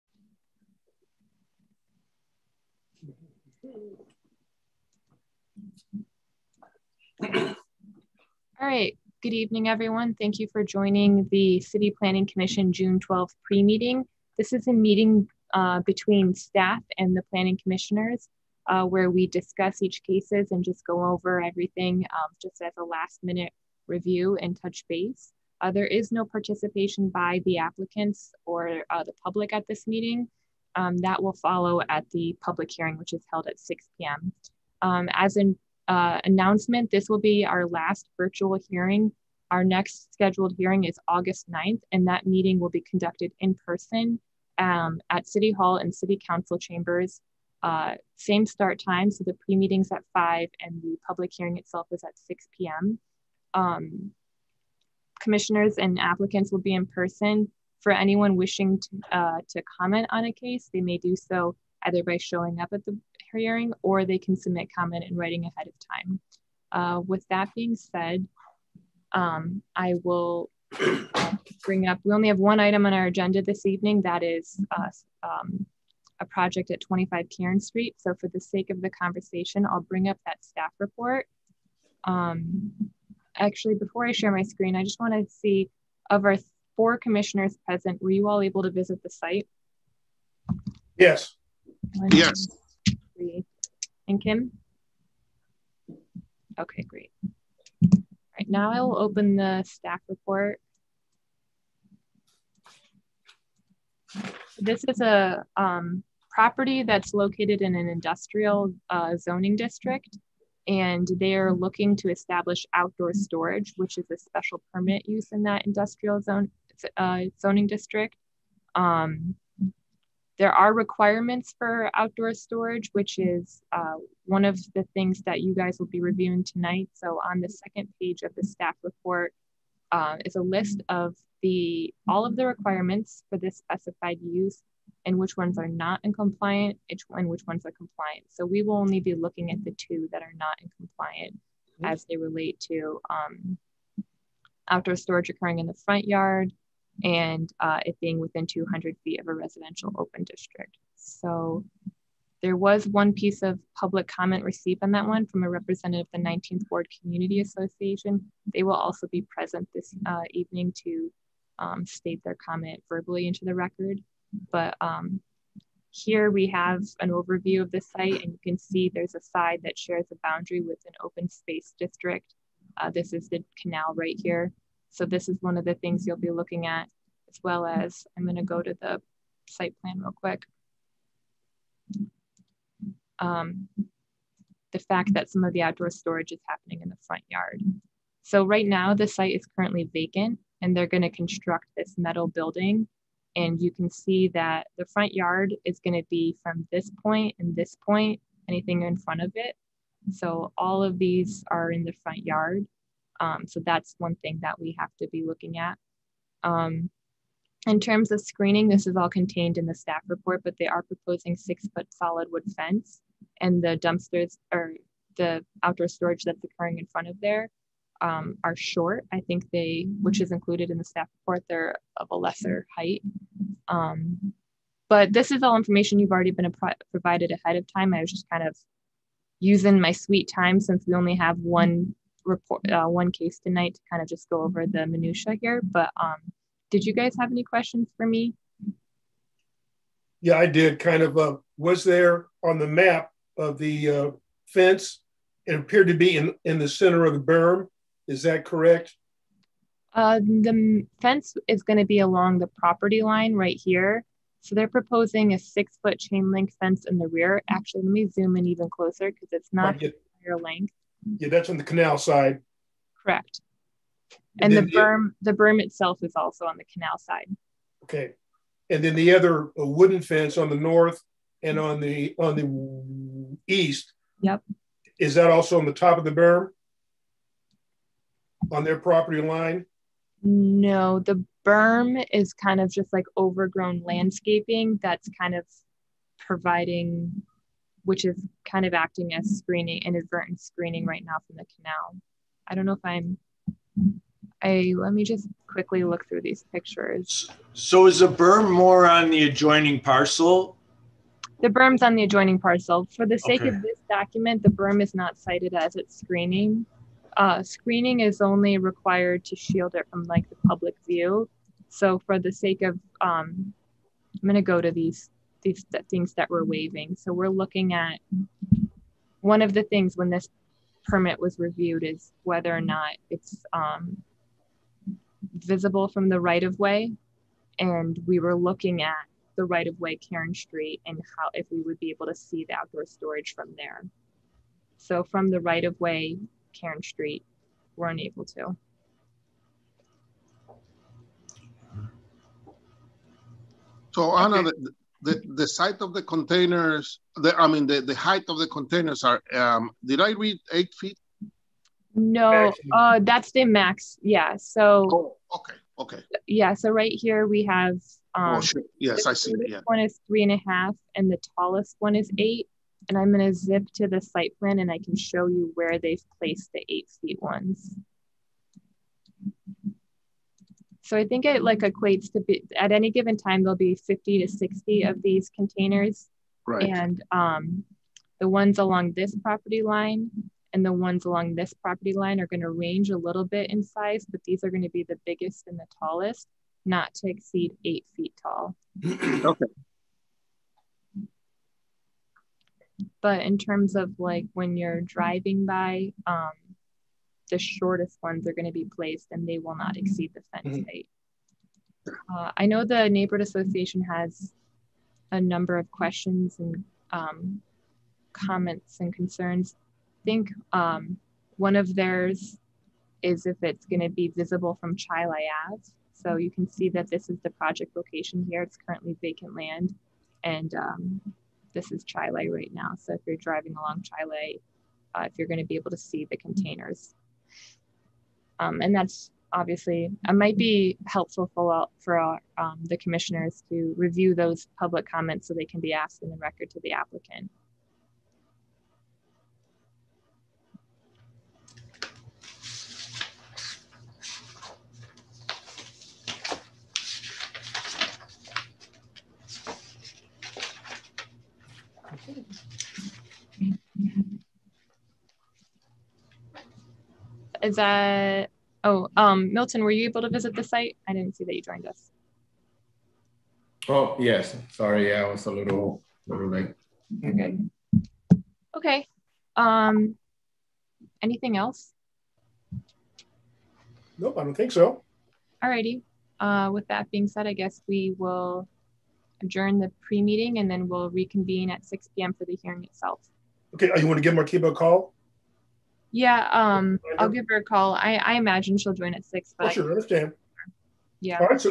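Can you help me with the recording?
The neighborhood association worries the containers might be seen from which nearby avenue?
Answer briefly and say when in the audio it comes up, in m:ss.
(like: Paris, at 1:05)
Chili Ave, at 6:54.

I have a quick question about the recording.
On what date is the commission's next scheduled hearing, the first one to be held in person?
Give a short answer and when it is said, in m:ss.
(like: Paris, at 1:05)
August 9th, at 0:41.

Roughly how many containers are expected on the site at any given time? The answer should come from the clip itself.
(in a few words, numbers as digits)
50 to 60.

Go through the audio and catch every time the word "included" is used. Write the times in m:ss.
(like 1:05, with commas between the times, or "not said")
3:40.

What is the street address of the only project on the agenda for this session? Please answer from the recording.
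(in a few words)
25 Cairn Street.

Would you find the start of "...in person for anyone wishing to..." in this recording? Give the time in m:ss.
0:56.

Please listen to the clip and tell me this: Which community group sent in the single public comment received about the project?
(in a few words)
19th Ward Community Association.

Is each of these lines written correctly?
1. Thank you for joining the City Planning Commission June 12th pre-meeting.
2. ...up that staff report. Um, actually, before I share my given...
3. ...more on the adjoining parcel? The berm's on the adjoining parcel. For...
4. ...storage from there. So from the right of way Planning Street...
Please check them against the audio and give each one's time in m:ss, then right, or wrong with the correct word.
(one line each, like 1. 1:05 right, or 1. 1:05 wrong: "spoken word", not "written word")
1. 0:10 right
2. 1:20 wrong: "screen", not "given"
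3. 4:58 right
4. 5:32 wrong: "Cairn", not "Planning".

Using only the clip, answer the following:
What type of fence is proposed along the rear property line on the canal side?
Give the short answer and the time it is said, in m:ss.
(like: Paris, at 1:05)
six foot chain link fence, at 4:15.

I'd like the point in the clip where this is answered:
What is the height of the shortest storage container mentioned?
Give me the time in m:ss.
6:00.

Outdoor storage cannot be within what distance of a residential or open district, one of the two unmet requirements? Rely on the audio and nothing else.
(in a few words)
200 feet.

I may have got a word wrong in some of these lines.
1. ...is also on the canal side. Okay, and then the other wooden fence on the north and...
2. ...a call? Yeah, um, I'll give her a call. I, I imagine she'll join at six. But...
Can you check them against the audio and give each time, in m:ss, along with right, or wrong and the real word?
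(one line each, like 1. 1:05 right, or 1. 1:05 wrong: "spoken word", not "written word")
1. 4:26 right
2. 8:04 right.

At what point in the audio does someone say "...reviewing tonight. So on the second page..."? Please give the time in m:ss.
2:06.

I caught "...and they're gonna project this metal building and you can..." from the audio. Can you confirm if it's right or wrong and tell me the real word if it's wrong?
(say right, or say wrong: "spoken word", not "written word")
wrong: "construct", not "project".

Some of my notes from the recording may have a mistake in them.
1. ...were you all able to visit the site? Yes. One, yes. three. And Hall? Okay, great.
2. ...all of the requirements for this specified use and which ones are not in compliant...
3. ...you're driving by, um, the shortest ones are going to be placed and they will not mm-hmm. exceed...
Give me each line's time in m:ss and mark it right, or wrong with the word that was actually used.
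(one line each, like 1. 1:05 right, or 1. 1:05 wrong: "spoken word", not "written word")
1. 1:28 wrong: "Kim", not "Hall"
2. 2:12 right
3. 6:34 right.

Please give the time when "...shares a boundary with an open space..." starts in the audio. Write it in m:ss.
2:49.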